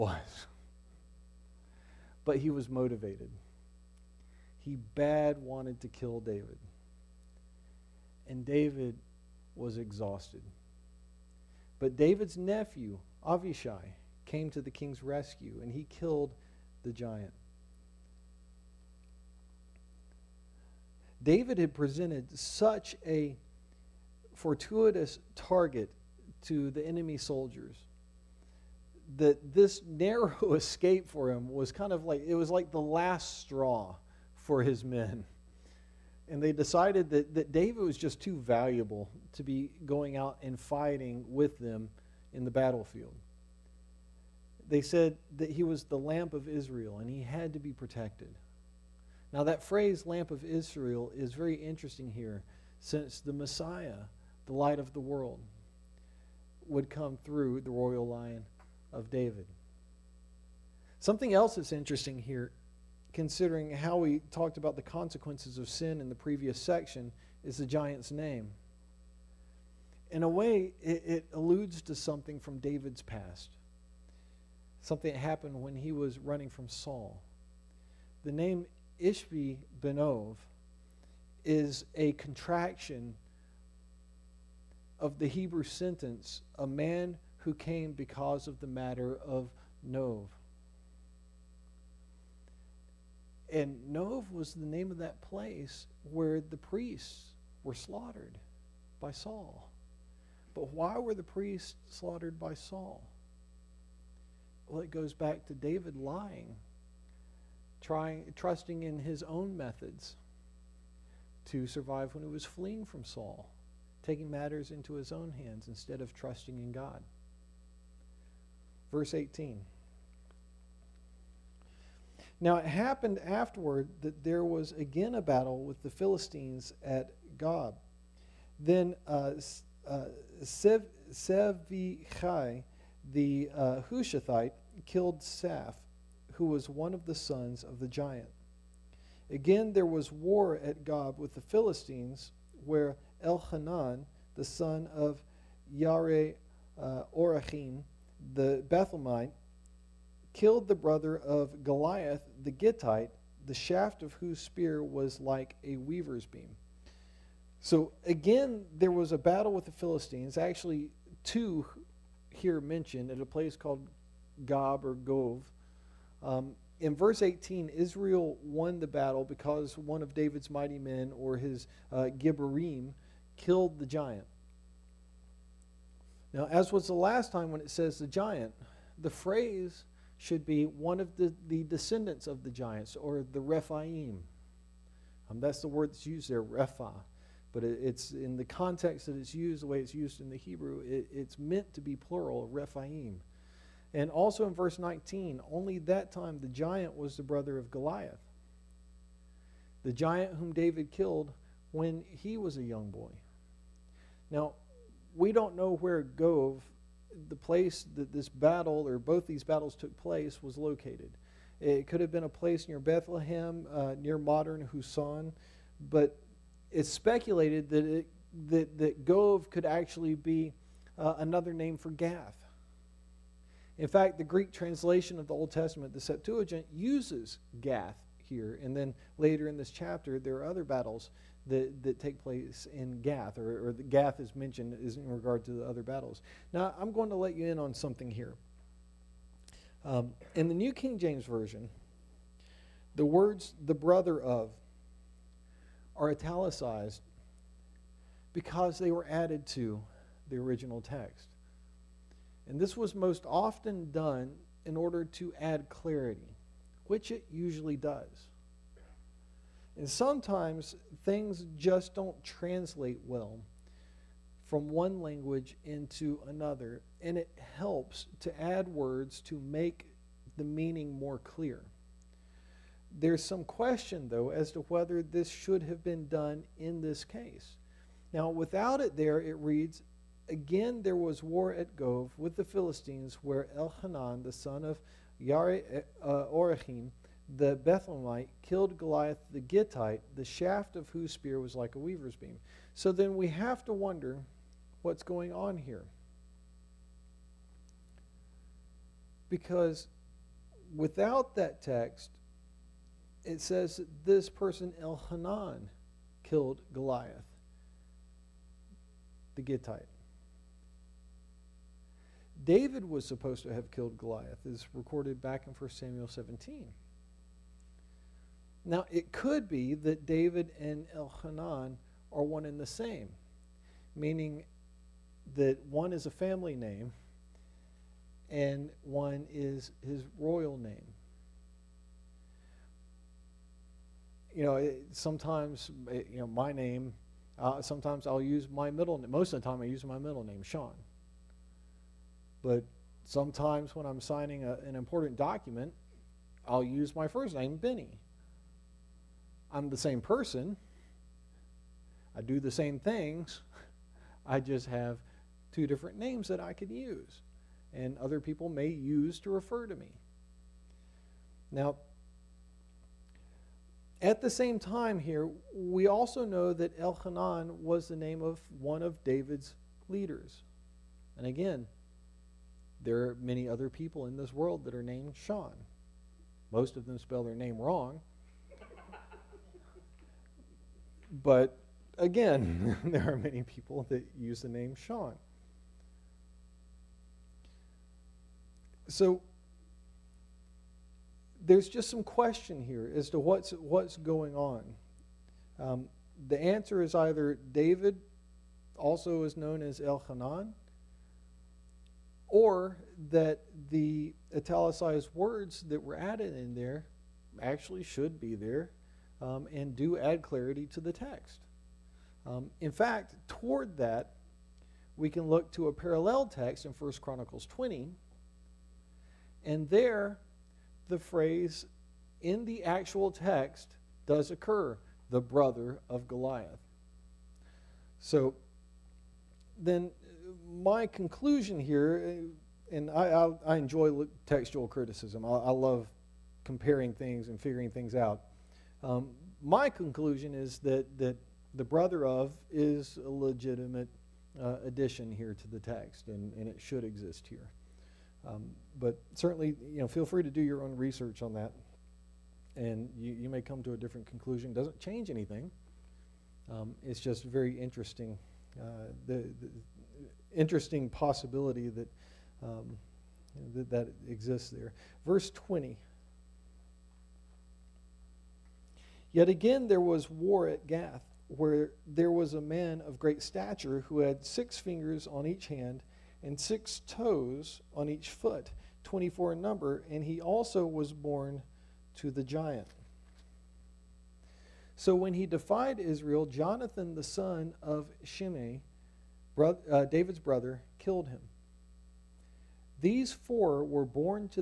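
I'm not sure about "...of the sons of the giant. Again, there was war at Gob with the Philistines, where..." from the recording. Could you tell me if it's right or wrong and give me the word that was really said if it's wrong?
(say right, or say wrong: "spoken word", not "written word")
right.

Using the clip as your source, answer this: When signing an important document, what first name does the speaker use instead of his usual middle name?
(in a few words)
Benny.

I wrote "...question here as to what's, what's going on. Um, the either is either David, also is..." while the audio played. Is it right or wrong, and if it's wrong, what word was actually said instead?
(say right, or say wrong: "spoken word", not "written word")
wrong: "answer", not "either".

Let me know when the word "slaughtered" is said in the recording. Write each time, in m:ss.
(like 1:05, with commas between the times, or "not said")
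1:37, 1:41.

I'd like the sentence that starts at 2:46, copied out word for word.
Um, in verse 18, Israel won the battle because one of David's mighty men, or his uh, Gibborim, killed the giant.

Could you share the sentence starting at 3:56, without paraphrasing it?
Now, I'm going to let you in on something here.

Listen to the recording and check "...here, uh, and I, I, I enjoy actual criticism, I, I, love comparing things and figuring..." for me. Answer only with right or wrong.
wrong.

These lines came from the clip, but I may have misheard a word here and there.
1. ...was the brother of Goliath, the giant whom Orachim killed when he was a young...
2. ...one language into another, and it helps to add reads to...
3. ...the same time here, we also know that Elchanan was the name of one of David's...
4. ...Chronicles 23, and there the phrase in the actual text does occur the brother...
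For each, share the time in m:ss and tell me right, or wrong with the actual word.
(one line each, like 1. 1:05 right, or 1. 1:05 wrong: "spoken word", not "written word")
1. 3:16 wrong: "David", not "Orachim"
2. 4:24 wrong: "words", not "reads"
3. 6:04 right
4. 6:56 wrong: "20", not "23".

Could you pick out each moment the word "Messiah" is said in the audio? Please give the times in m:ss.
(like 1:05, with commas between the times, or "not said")
0:53.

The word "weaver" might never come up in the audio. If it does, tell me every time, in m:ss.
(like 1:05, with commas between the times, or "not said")
2:35, 4:51.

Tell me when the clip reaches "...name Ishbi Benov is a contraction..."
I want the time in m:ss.
1:18.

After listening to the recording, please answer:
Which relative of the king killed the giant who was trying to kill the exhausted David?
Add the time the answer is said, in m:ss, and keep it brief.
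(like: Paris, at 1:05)
Avishai, at 0:13.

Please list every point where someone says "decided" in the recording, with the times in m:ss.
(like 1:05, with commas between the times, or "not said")
0:36.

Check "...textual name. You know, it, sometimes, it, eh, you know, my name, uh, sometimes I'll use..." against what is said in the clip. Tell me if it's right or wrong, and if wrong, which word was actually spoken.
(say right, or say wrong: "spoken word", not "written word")
wrong: "royal", not "textual".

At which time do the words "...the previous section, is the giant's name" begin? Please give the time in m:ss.
1:06.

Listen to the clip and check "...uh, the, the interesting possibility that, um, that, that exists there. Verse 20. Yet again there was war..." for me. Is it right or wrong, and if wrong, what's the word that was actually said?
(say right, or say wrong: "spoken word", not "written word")
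right.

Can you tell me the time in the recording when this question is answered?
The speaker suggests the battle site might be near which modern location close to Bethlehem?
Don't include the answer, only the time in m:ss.
3:34.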